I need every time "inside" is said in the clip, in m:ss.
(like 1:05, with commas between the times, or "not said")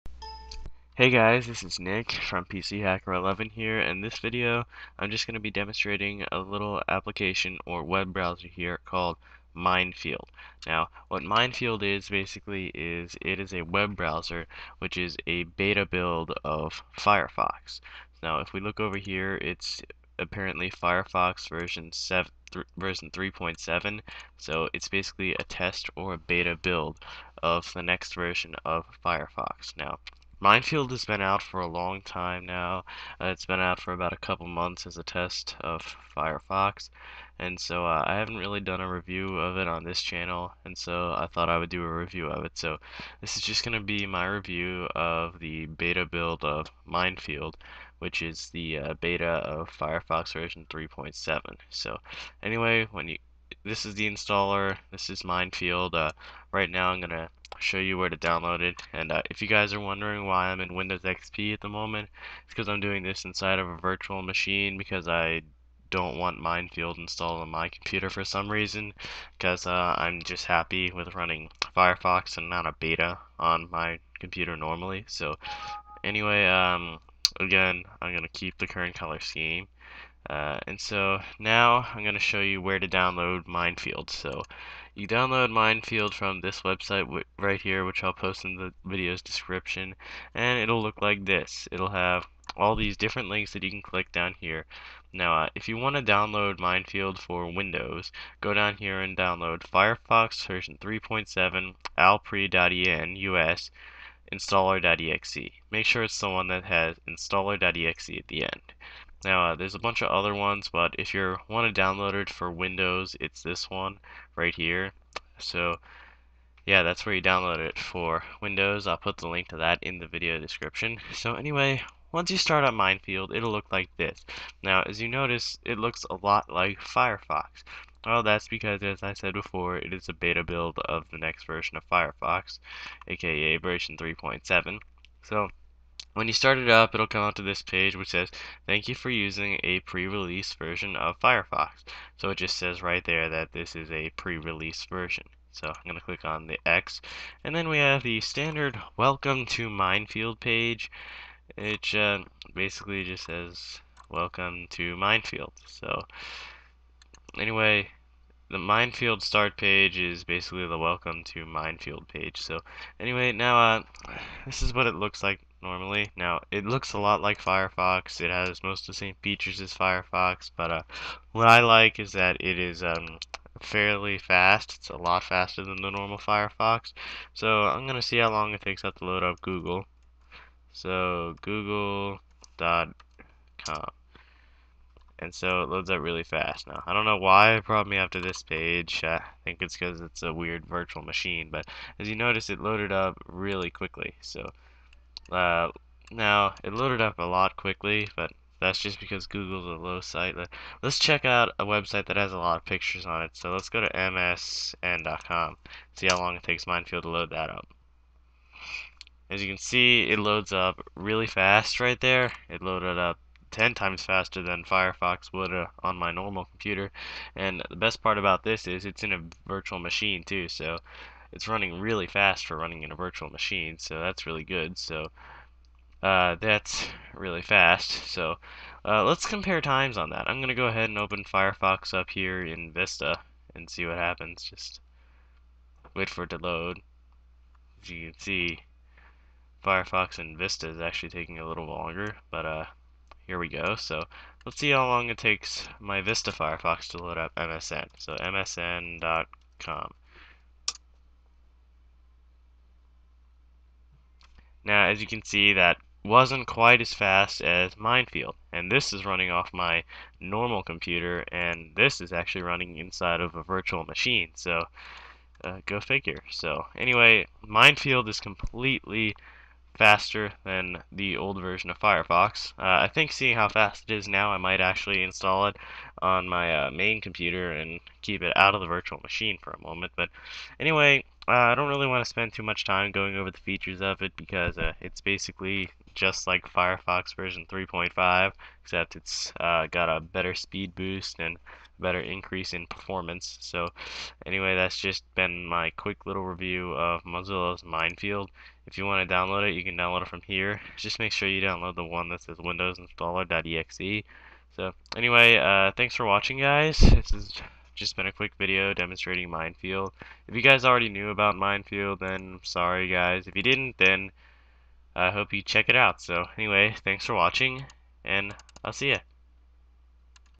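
1:03, 4:22.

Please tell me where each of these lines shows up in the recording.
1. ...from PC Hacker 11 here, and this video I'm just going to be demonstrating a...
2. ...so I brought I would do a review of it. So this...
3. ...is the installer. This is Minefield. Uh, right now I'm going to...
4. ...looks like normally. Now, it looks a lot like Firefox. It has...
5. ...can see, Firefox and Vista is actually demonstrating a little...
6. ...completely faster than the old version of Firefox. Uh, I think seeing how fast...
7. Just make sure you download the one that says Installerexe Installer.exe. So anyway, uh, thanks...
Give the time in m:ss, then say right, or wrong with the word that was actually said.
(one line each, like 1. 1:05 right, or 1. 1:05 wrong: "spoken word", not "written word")
1. 0:02 right
2. 0:40 wrong: "thought", not "brought"
3. 0:53 right
4. 2:44 right
5. 3:58 wrong: "taking", not "demonstrating"
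6. 4:28 right
7. 5:00 wrong: "Windows", not "Installerexe".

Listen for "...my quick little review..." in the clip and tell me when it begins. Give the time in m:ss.
4:55.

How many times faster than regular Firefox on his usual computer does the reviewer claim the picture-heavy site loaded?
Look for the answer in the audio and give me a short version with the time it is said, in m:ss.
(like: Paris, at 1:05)
10, at 3:33.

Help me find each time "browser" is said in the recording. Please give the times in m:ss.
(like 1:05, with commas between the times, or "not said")
0:08, 0:13.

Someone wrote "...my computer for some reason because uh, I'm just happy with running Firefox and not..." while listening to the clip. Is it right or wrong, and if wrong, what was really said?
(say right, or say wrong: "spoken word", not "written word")
right.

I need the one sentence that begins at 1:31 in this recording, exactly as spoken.
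It'll have all these different links that you can click down here.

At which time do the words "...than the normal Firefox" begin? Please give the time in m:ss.
2:55.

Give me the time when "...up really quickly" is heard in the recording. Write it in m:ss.
3:12.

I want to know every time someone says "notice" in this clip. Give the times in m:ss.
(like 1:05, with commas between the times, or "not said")
2:05, 3:12.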